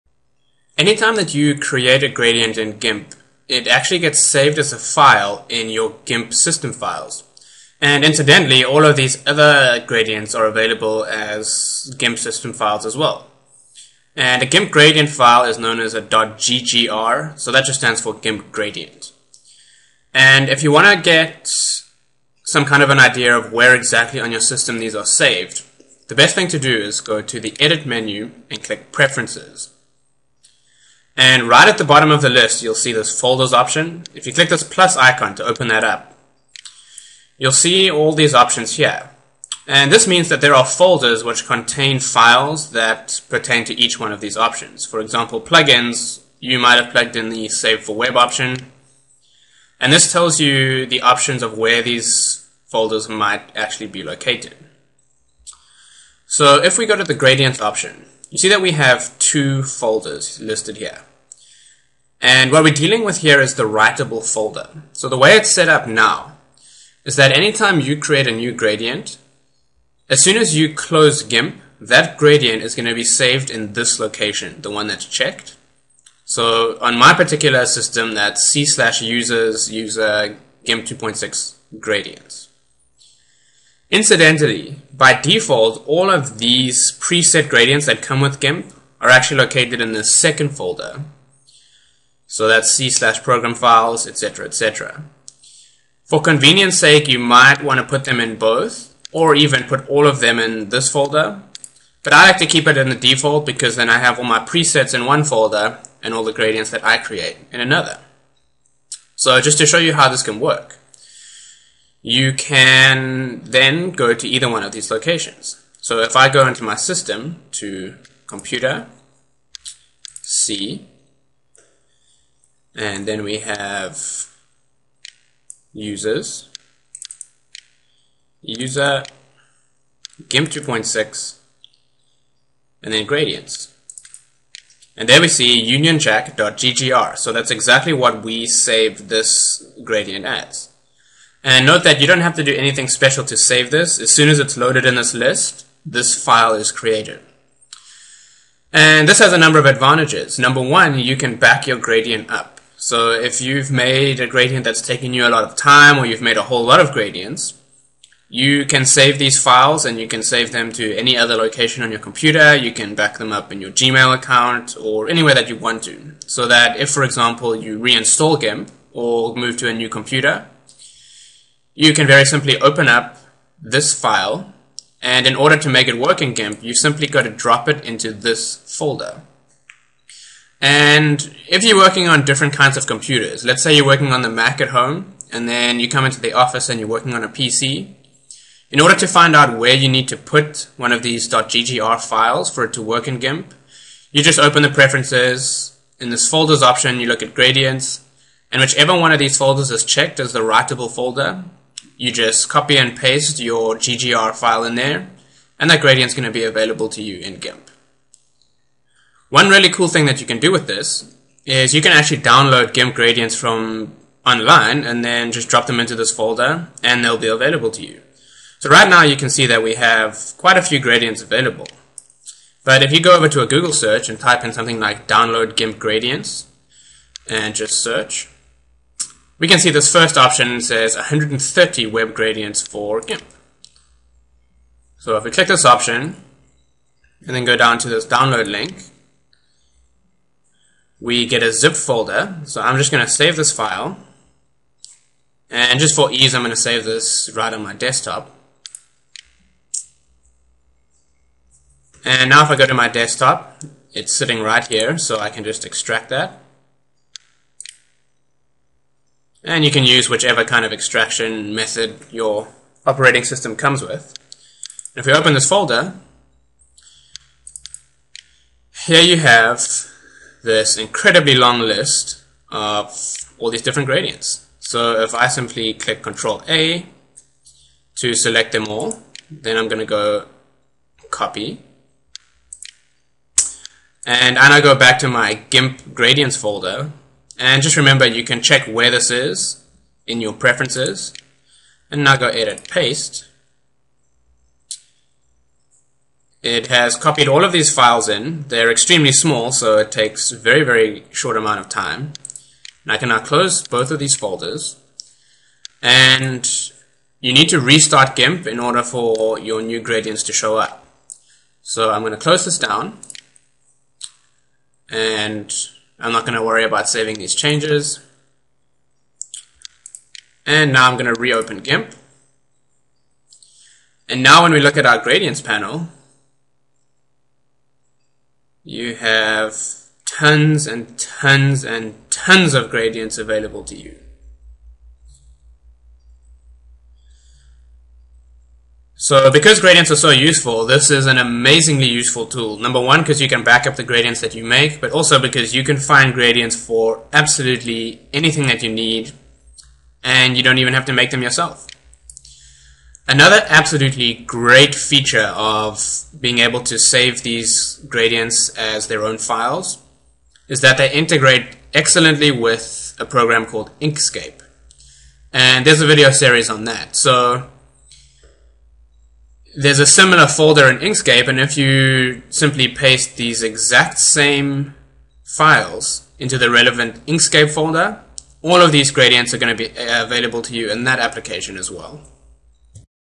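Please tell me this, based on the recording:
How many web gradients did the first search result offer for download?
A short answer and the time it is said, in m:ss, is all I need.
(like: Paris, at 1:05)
130, at 3:50.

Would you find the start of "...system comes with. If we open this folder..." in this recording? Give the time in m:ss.
4:23.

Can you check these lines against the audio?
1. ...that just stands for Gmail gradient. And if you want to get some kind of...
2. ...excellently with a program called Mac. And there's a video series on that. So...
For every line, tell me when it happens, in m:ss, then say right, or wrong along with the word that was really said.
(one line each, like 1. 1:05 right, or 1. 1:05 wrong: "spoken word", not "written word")
1. 0:17 wrong: "GIMP", not "Gmail"
2. 6:01 wrong: "Inkscape", not "Mac".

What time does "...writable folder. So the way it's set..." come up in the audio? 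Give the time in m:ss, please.
1:03.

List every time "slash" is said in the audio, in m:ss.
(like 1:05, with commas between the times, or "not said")
1:18, 1:32.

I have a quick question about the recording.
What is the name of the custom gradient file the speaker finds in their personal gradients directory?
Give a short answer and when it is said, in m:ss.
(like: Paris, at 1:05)
unionjack.ggr, at 2:15.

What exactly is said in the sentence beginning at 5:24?
And now when we look at our gradients panel, you have tons and tons and tons of gradients available to you.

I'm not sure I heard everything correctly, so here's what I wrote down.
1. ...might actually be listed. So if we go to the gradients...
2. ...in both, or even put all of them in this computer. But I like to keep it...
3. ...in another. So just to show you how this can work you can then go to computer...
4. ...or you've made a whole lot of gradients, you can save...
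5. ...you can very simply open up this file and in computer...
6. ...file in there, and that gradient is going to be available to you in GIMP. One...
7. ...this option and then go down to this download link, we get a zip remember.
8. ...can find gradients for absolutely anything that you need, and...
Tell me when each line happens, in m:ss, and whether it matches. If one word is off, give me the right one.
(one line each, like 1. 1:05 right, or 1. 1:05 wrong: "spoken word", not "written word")
1. 0:53 wrong: "located", not "listed"
2. 1:38 wrong: "folder", not "computer"
3. 1:47 wrong: "either", not "computer"
4. 2:35 right
5. 2:51 wrong: "order", not "computer"
6. 3:24 right
7. 3:55 wrong: "folder", not "remember"
8. 5:45 right.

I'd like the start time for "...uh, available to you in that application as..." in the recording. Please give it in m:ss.
6:19.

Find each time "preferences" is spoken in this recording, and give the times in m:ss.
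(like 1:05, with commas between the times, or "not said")
0:28, 3:14, 4:50.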